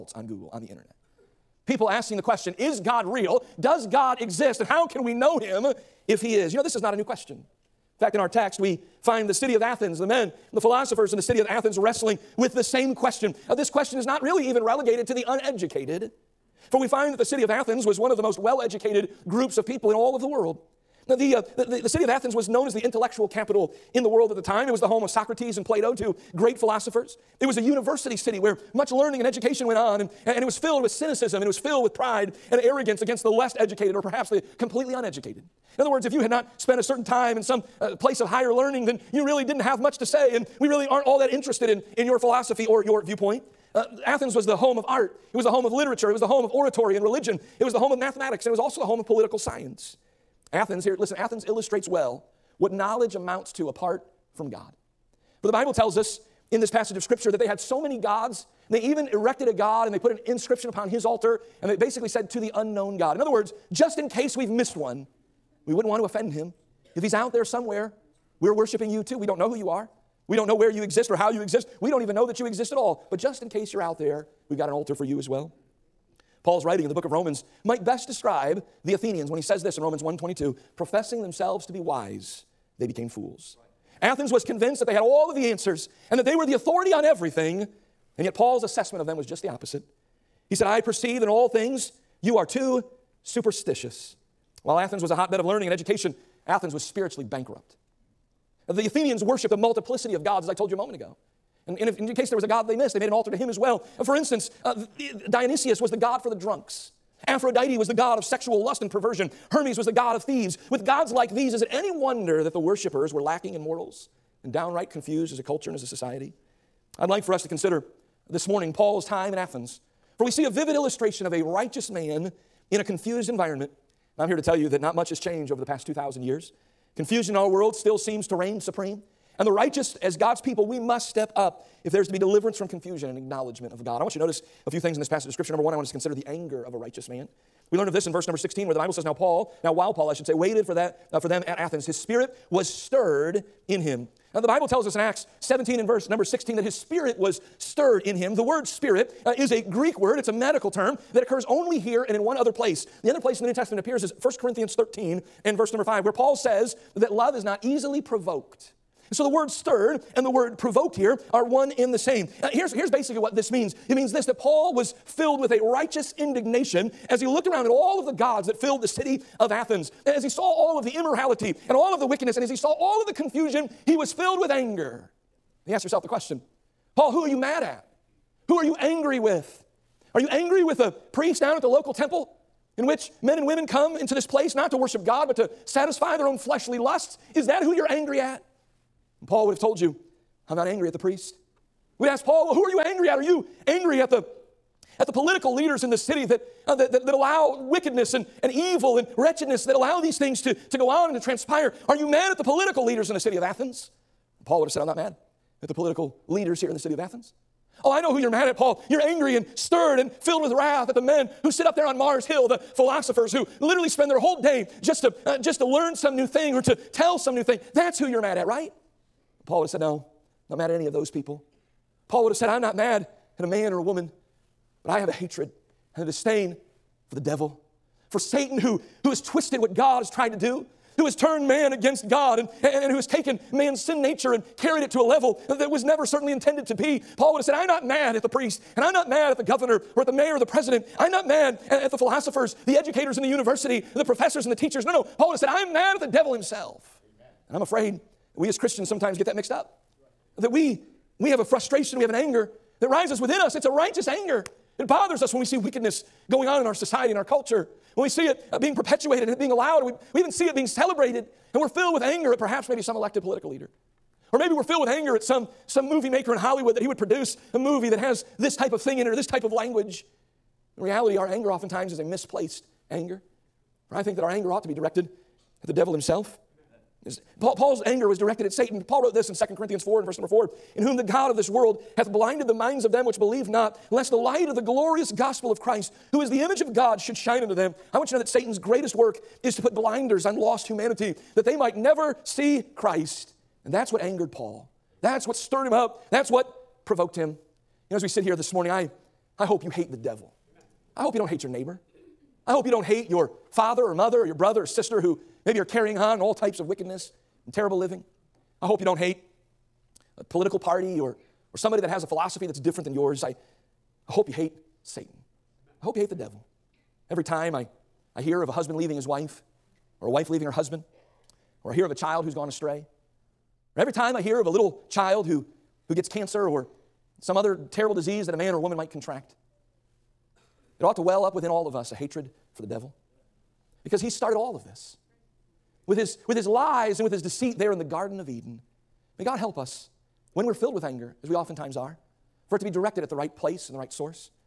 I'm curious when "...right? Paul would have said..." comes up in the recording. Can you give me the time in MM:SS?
03:38.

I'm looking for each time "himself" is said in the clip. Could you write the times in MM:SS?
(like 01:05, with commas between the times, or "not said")
04:06, 04:35.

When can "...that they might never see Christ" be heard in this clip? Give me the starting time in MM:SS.
04:51.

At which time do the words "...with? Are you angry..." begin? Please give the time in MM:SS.
02:59.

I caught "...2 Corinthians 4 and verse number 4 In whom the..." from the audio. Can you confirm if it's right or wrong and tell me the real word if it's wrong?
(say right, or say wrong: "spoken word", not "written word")
right.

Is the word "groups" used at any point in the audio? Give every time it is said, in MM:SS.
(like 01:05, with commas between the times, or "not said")
00:19.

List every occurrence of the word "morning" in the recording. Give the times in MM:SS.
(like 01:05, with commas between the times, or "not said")
01:58, 04:58.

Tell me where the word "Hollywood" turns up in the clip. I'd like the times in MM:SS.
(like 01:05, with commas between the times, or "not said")
04:26.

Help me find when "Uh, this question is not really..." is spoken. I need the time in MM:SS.
00:13.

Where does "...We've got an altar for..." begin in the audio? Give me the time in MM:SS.
01:14.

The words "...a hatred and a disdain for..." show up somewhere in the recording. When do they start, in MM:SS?
03:45.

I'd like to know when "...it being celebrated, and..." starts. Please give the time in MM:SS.
04:20.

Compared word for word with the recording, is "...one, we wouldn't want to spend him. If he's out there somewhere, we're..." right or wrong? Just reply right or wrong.
wrong.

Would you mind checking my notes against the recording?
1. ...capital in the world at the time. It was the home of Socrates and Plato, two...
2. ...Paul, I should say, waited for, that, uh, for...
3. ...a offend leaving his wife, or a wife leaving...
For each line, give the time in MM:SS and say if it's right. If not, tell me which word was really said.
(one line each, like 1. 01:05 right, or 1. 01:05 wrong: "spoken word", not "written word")
1. 00:23 right
2. 02:19 right
3. 05:18 wrong: "husband", not "offend".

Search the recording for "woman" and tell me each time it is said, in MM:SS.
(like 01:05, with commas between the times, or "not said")
03:43, 05:28.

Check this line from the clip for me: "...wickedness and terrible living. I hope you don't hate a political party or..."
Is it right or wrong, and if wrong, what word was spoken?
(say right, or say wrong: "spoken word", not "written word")
right.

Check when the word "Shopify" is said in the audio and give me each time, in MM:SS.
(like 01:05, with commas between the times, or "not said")
not said.